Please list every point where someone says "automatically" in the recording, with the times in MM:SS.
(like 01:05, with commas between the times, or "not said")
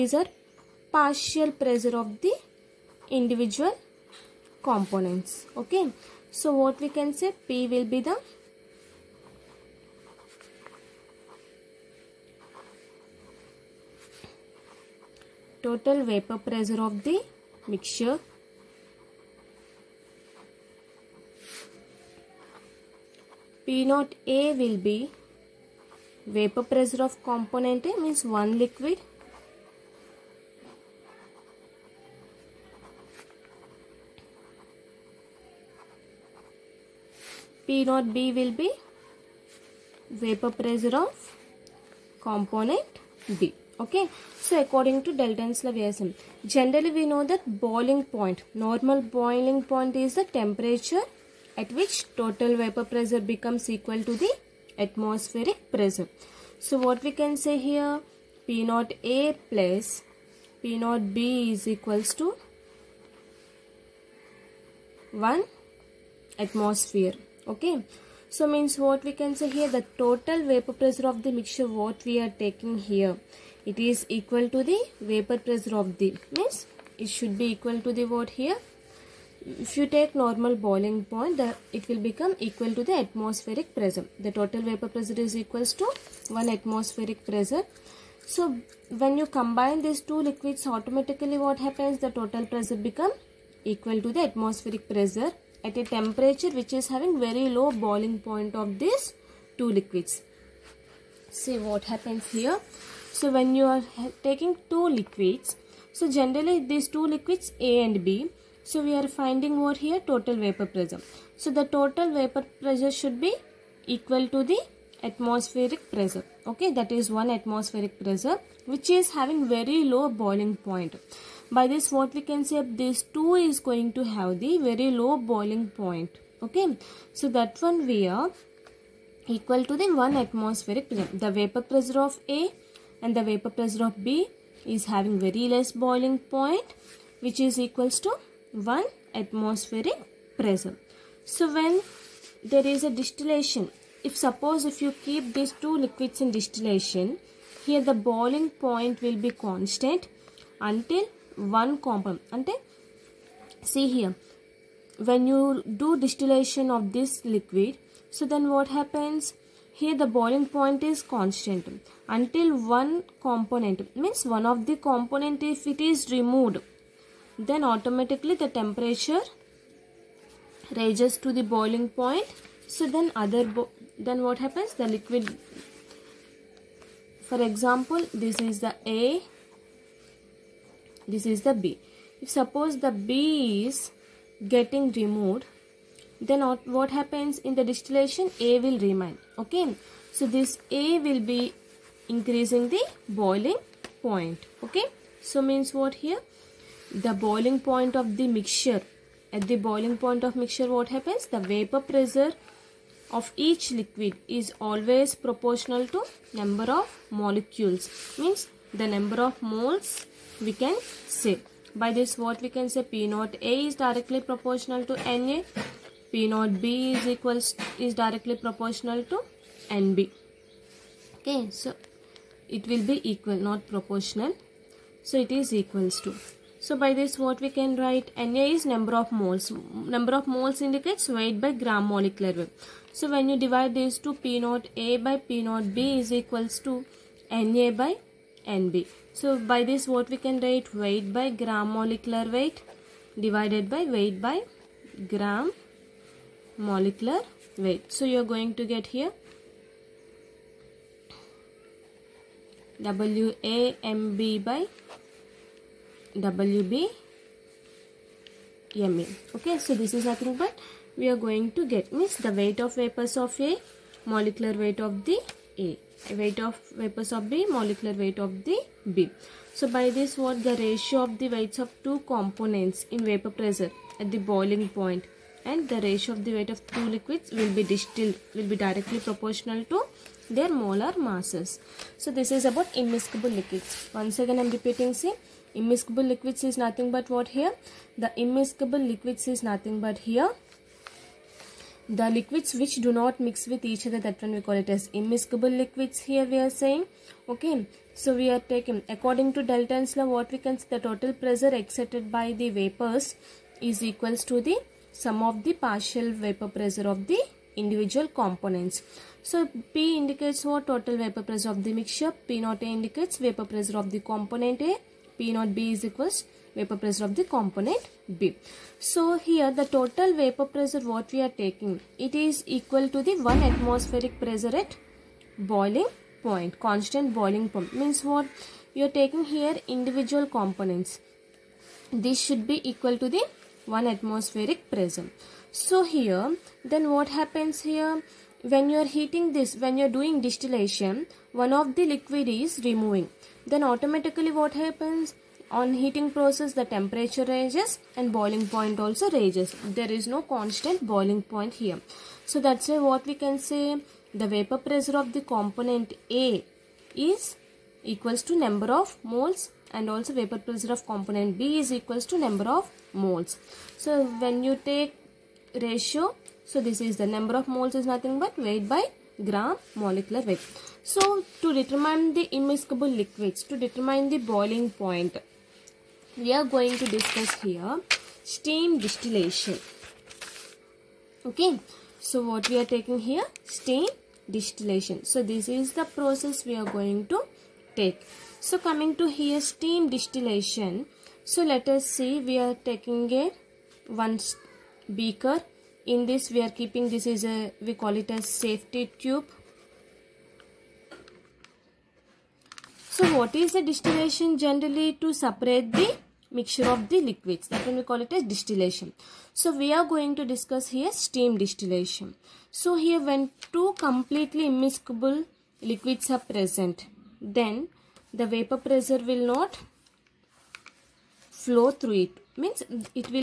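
01:30, 02:47, 05:43.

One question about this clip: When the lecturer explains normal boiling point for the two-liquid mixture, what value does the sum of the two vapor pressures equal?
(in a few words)
1 atmosphere.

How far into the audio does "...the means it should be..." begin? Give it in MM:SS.
01:15.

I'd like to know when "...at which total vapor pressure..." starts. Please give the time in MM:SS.
00:51.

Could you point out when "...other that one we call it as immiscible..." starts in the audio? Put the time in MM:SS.
04:53.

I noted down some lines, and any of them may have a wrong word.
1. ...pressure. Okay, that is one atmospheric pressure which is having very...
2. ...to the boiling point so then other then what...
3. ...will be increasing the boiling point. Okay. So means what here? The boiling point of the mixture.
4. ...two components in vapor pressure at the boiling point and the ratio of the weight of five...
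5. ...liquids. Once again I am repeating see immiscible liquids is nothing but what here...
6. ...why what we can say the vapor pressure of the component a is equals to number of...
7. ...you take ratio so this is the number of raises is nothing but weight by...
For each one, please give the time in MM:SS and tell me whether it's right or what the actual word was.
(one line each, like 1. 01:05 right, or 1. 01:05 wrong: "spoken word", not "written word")
1. 01:55 right
2. 02:51 right
3. 03:10 right
4. 04:31 wrong: "two", not "five"
5. 04:43 right
6. 05:52 right
7. 06:04 wrong: "moles", not "raises".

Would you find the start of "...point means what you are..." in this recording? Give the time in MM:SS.
05:27.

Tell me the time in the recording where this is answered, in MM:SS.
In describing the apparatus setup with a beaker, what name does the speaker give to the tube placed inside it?
06:38.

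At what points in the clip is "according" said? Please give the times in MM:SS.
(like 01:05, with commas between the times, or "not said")
00:44, 04:58.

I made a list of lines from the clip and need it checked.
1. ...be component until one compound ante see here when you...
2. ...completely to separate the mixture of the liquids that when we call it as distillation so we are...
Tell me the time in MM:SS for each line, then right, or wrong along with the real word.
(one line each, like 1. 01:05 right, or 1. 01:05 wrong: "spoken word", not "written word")
1. 02:29 wrong: "constant", not "component"
2. 06:44 wrong: "generally", not "completely".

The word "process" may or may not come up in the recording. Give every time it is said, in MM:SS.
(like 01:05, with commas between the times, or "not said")
05:46, 06:25.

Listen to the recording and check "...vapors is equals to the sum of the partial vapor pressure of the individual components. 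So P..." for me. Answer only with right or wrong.
right.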